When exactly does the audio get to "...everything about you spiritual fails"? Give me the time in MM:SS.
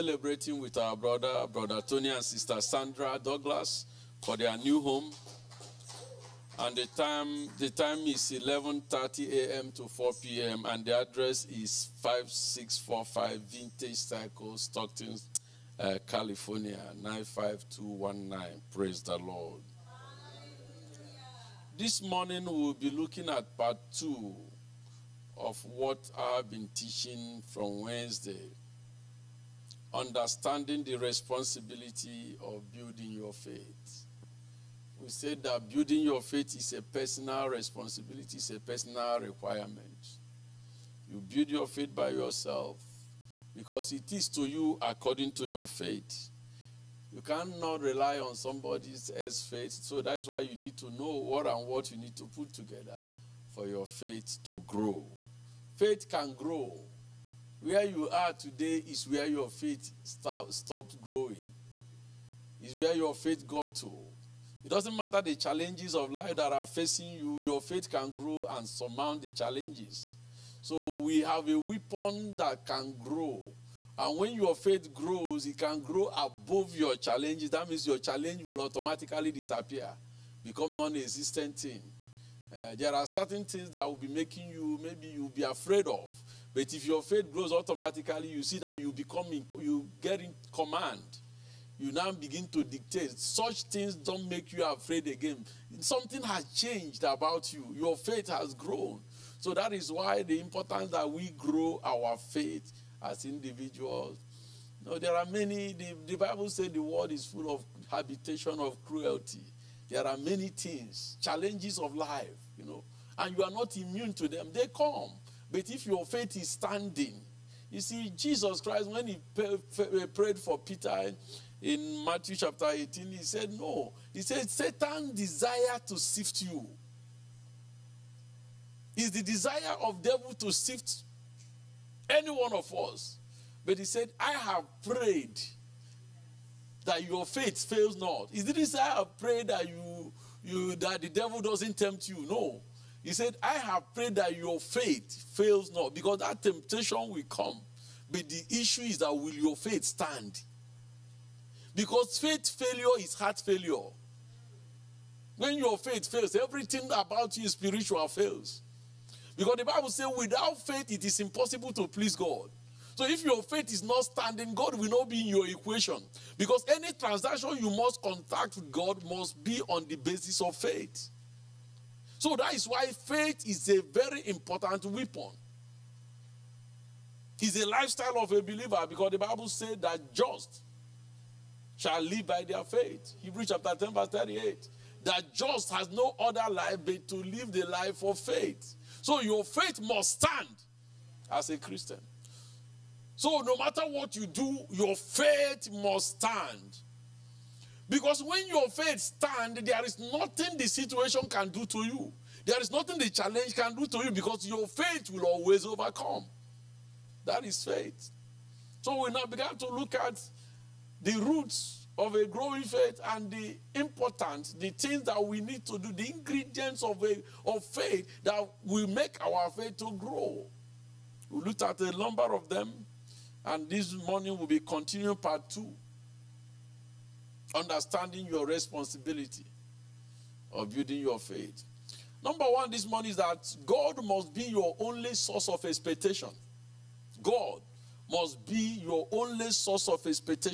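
02:36.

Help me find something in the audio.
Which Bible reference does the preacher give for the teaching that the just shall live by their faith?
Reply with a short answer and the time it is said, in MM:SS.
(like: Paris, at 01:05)
Hebrews 10:38, at 03:03.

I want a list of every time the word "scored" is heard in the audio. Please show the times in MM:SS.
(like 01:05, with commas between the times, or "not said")
not said.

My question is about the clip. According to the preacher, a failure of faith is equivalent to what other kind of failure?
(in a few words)
Heart failure.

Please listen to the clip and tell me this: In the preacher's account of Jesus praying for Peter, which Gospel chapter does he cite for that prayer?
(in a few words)
Matthew chapter 18.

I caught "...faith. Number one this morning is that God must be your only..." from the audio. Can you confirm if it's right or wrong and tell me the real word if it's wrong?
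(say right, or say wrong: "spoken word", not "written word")
right.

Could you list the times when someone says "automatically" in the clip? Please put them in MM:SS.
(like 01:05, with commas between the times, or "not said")
01:18, 01:27.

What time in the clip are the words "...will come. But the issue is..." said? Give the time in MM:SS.
02:27.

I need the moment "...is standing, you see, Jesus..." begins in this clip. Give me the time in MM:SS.
01:56.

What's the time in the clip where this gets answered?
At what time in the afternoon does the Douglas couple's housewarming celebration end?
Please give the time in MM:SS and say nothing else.
00:09.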